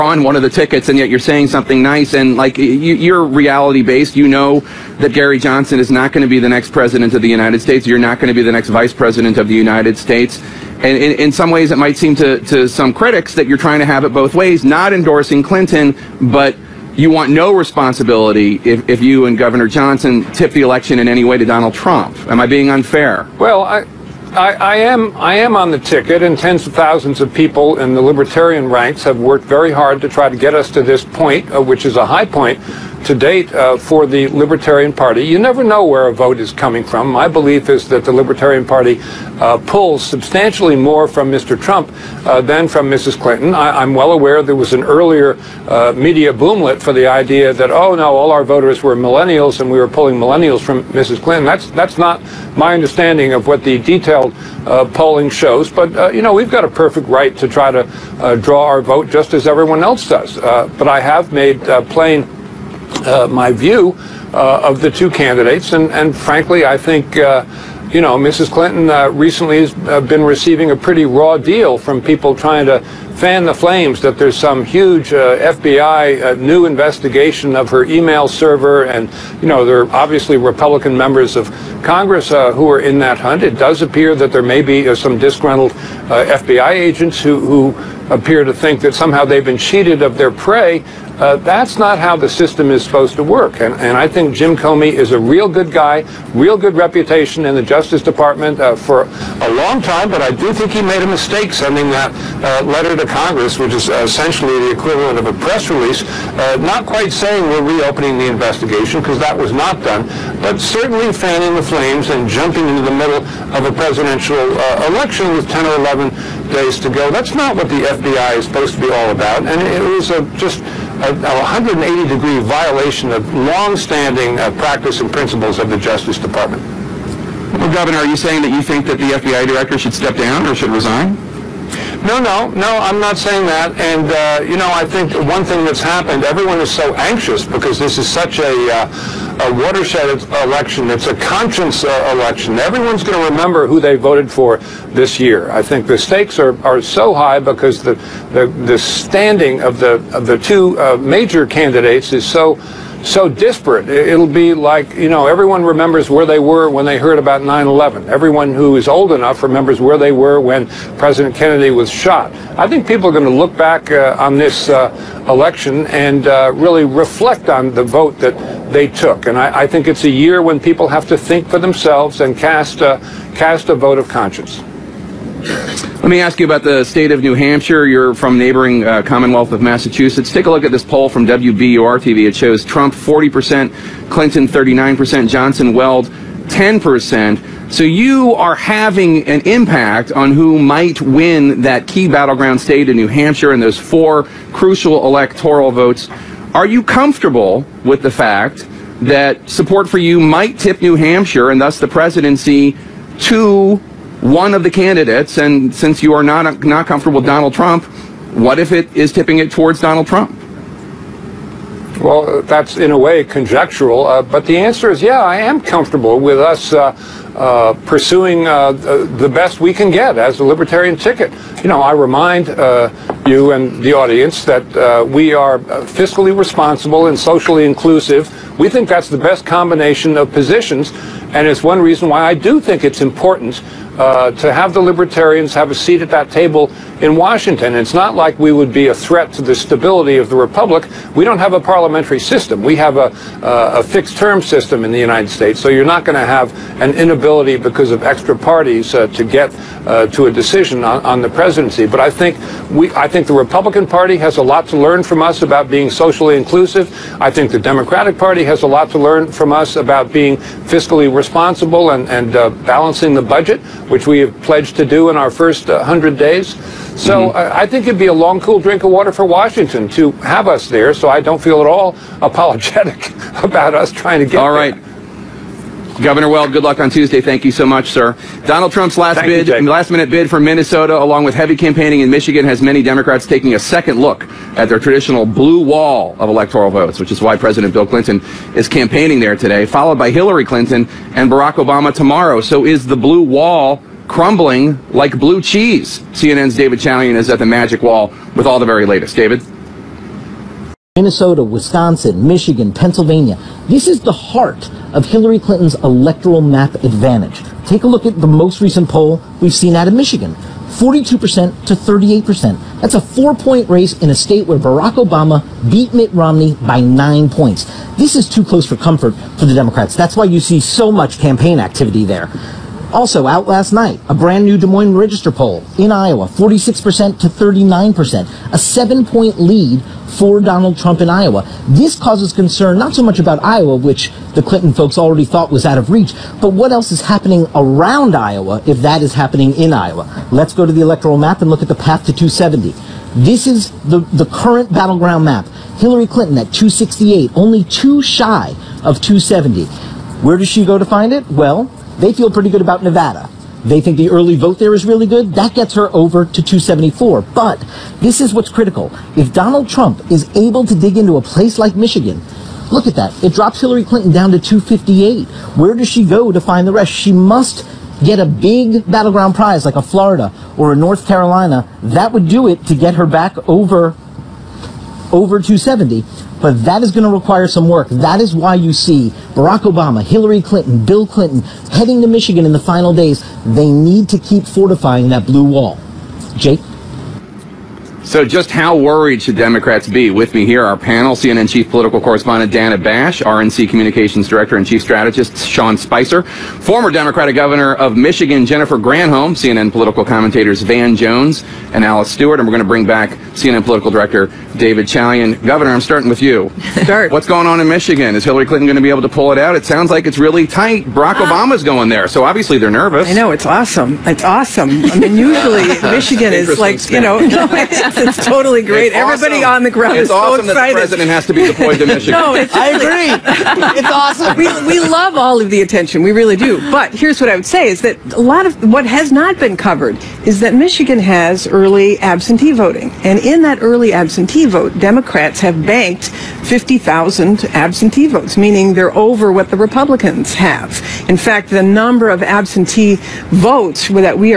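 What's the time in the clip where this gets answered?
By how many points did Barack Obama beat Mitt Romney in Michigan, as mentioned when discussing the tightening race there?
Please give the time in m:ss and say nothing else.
5:16.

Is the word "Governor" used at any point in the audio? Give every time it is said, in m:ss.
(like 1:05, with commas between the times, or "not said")
0:19, 2:07, 4:36, 6:37, 6:45.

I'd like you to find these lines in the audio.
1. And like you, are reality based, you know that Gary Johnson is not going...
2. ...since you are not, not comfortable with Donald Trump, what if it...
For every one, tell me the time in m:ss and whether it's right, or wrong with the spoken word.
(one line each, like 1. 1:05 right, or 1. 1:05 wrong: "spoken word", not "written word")
1. 0:02 right
2. 3:25 right.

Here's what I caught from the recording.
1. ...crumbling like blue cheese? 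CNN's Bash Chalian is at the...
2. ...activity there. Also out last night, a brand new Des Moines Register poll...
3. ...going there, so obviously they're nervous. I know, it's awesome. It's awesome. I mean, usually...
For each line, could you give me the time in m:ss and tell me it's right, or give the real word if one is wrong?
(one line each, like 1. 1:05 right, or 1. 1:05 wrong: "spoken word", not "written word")
1. 4:54 wrong: "David", not "Bash"
2. 5:21 right
3. 6:51 right.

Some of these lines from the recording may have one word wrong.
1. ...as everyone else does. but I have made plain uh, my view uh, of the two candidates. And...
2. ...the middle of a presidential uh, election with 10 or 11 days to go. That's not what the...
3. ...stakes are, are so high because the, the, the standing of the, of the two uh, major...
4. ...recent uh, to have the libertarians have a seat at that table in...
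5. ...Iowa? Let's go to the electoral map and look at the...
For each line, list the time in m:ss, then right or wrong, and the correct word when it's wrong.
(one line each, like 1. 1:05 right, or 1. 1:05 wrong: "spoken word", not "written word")
1. 0:59 right
2. 1:52 right
3. 2:25 right
4. 3:53 wrong: "important", not "recent"
5. 5:39 right.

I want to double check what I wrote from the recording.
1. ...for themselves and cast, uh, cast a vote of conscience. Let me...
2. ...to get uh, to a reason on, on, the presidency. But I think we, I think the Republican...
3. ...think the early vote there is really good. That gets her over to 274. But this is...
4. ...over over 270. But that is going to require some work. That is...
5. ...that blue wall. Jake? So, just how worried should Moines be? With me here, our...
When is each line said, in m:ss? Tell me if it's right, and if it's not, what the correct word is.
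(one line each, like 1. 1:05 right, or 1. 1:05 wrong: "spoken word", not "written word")
1. 2:51 right
2. 4:09 wrong: "decision", not "reason"
3. 5:53 right
4. 6:13 right
5. 6:25 wrong: "Democrats", not "Moines".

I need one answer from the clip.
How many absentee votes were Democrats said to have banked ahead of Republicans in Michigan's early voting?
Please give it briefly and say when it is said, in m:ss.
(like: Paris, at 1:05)
50,000, at 7:16.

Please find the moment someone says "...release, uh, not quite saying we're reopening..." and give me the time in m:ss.
1:45.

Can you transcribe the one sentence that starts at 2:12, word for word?
No, no, no, I'm not saying that.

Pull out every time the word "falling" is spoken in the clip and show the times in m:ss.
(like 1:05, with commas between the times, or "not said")
not said.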